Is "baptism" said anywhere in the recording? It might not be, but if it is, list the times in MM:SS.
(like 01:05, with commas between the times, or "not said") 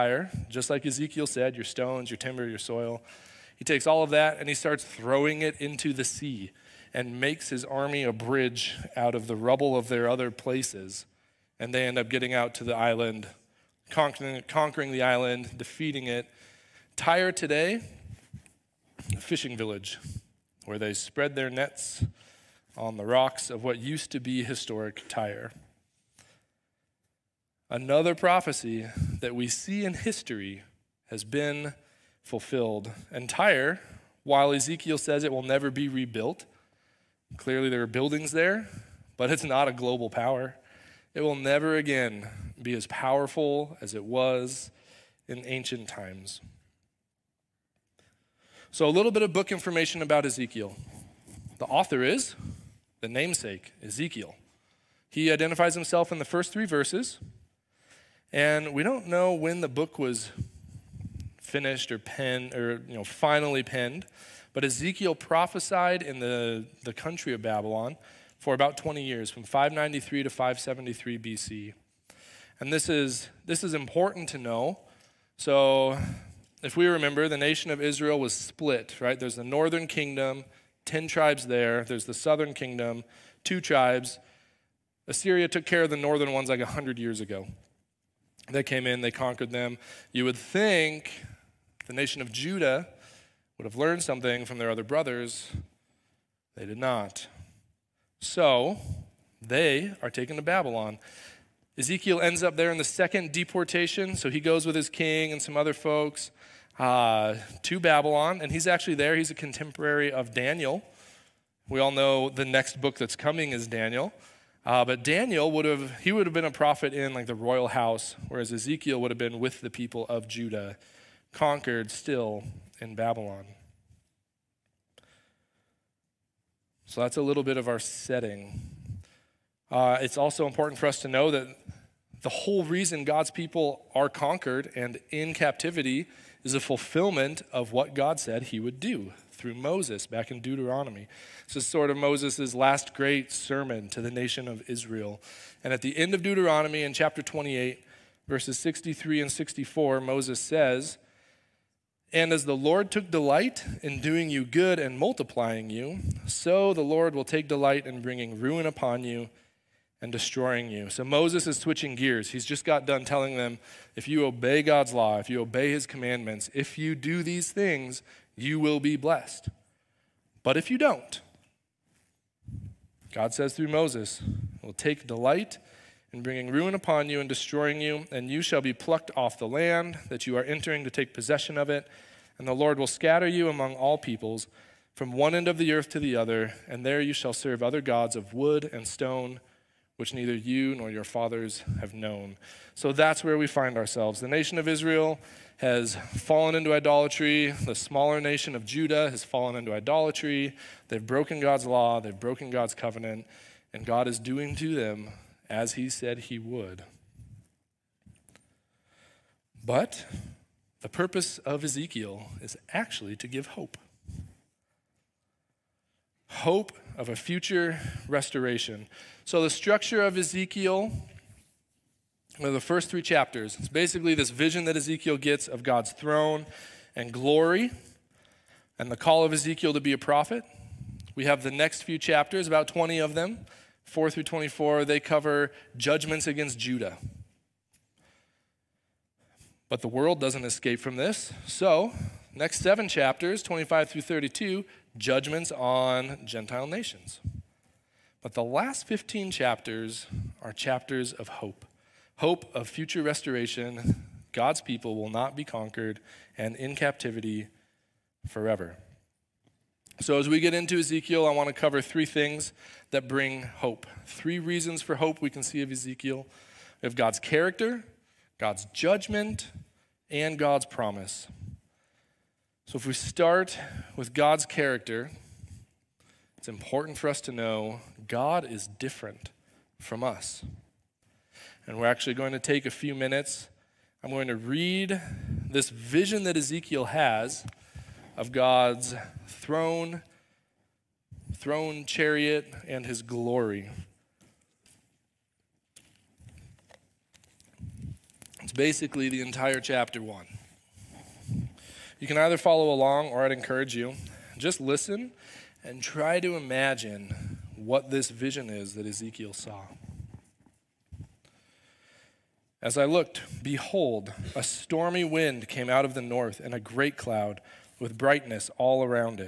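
not said.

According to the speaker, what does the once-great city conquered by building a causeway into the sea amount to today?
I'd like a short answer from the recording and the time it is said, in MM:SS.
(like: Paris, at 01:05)
A fishing village, at 00:19.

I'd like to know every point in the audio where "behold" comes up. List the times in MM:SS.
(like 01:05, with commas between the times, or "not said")
05:13.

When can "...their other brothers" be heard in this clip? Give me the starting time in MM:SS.
01:34.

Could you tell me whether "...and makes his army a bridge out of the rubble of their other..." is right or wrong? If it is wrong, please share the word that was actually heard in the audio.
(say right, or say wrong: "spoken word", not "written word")
right.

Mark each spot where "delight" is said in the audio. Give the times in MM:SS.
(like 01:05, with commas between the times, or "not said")
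02:33, 02:37, 02:55.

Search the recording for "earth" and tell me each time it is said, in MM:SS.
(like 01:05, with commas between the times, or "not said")
03:05.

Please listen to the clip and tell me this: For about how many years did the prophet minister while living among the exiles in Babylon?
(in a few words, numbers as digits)
20.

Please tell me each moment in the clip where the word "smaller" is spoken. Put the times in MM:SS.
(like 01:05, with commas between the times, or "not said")
03:17.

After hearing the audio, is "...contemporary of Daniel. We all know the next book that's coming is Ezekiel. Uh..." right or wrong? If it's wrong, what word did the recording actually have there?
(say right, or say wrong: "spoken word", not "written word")
wrong: "Daniel", not "Ezekiel".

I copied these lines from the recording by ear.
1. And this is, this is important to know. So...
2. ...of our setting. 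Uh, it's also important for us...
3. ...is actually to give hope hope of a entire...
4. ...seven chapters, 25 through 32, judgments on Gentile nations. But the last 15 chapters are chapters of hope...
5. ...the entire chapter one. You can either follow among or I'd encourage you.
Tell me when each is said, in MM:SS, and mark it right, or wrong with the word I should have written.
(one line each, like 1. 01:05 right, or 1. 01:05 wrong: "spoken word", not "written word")
1. 01:12 right
2. 02:07 right
3. 03:32 wrong: "future", not "entire"
4. 04:02 right
5. 04:59 wrong: "along", not "among".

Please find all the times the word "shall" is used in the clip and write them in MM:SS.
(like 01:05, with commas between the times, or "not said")
02:58, 03:07.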